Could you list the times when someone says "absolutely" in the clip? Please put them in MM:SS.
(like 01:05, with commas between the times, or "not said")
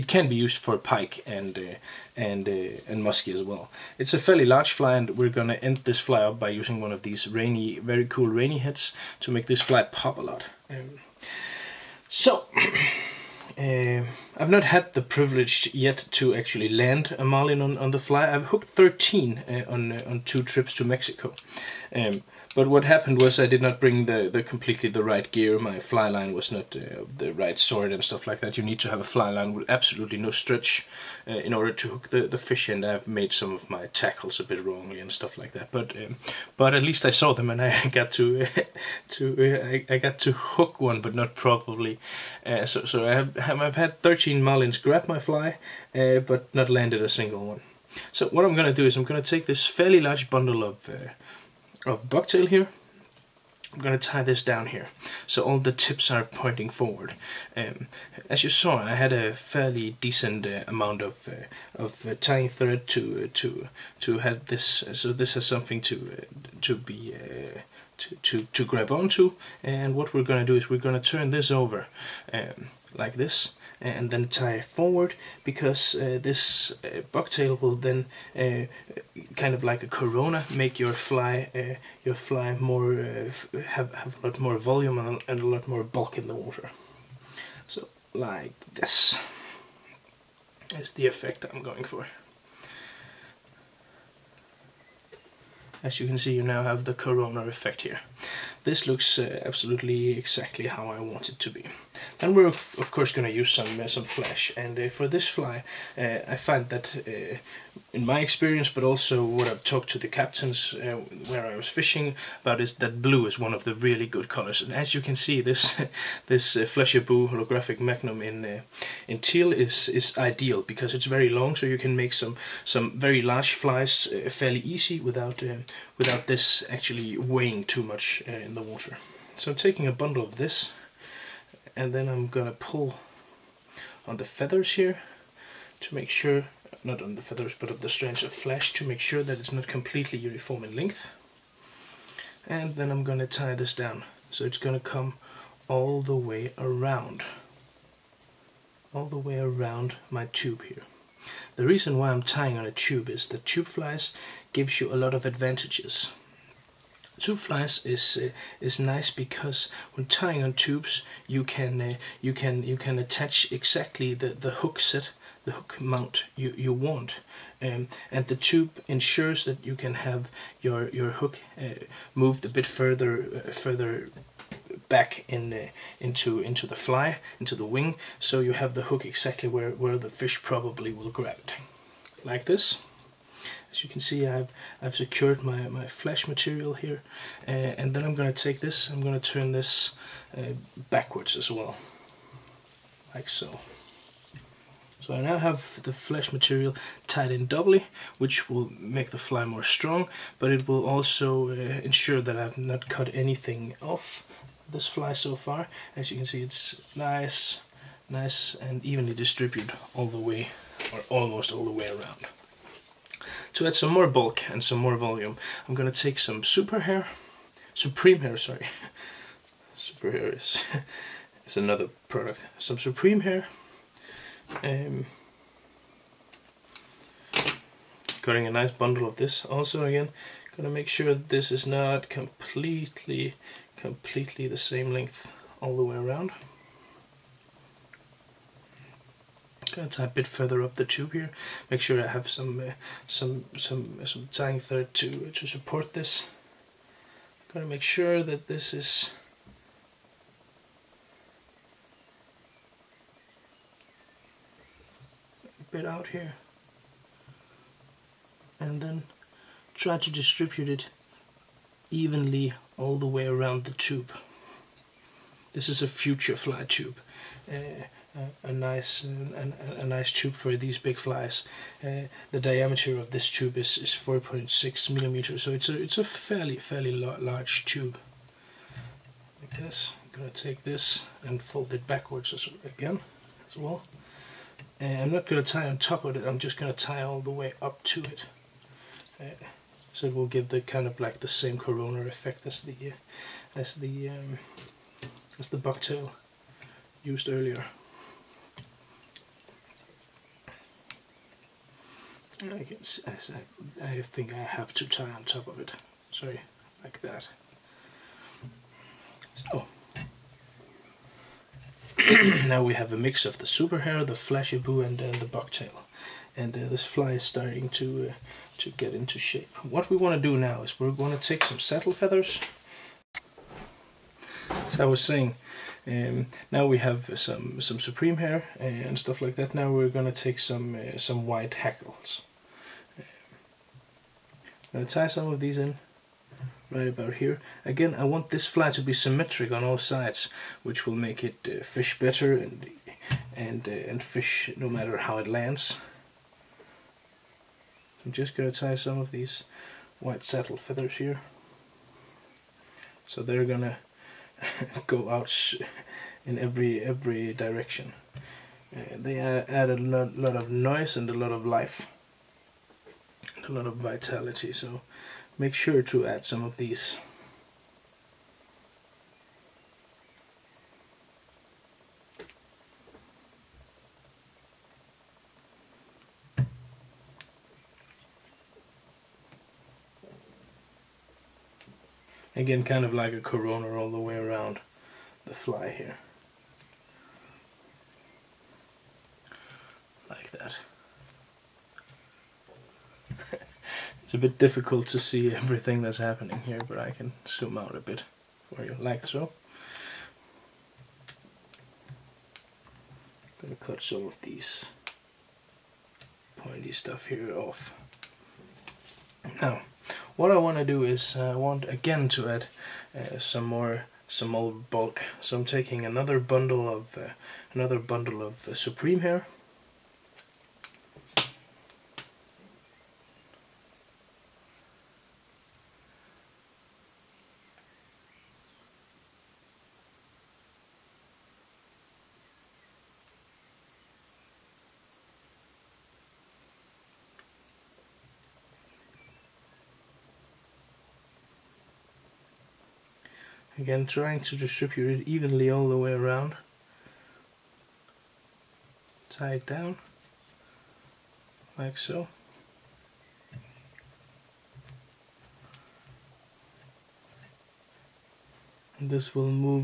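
00:29, 01:39.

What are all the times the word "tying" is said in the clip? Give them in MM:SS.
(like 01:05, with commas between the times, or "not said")
01:02, 02:32, 02:40.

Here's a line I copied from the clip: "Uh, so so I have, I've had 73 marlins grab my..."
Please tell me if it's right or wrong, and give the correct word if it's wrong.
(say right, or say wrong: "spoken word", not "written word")
wrong: "13", not "73".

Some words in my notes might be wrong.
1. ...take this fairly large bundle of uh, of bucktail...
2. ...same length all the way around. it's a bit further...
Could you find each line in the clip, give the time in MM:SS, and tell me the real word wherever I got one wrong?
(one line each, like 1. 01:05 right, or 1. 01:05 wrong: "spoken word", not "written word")
1. 00:49 right
2. 03:54 right.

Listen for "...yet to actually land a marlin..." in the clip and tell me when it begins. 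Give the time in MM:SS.
00:15.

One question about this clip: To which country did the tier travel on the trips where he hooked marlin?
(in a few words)
Mexico.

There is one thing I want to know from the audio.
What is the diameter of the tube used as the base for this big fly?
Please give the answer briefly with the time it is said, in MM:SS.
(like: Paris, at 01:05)
4.6 millimeters, at 04:33.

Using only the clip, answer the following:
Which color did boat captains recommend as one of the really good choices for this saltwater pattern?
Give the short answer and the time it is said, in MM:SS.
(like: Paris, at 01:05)
Blue, at 01:53.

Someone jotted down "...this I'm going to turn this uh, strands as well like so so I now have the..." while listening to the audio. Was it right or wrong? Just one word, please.
wrong.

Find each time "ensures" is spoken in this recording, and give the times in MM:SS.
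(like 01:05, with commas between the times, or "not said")
02:48, 03:21.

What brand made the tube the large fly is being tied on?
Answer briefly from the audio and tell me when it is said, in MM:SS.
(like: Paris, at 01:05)
FutureFly, at 04:25.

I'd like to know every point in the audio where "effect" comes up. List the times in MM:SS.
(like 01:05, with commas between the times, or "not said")
01:31, 01:37, 04:52.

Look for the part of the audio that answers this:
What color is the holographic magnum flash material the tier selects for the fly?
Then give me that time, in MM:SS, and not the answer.
01:59.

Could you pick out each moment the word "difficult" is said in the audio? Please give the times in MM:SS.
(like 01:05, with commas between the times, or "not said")
06:34.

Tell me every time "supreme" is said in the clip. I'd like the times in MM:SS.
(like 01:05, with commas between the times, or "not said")
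03:37, 03:42, 05:27, 06:58.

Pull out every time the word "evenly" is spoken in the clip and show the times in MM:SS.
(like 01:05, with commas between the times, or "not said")
03:28, 04:21, 07:25.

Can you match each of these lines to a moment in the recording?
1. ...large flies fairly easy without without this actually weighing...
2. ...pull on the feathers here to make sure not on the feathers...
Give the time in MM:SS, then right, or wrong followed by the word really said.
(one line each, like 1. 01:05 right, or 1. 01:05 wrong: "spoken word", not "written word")
1. 02:03 right
2. 02:12 right.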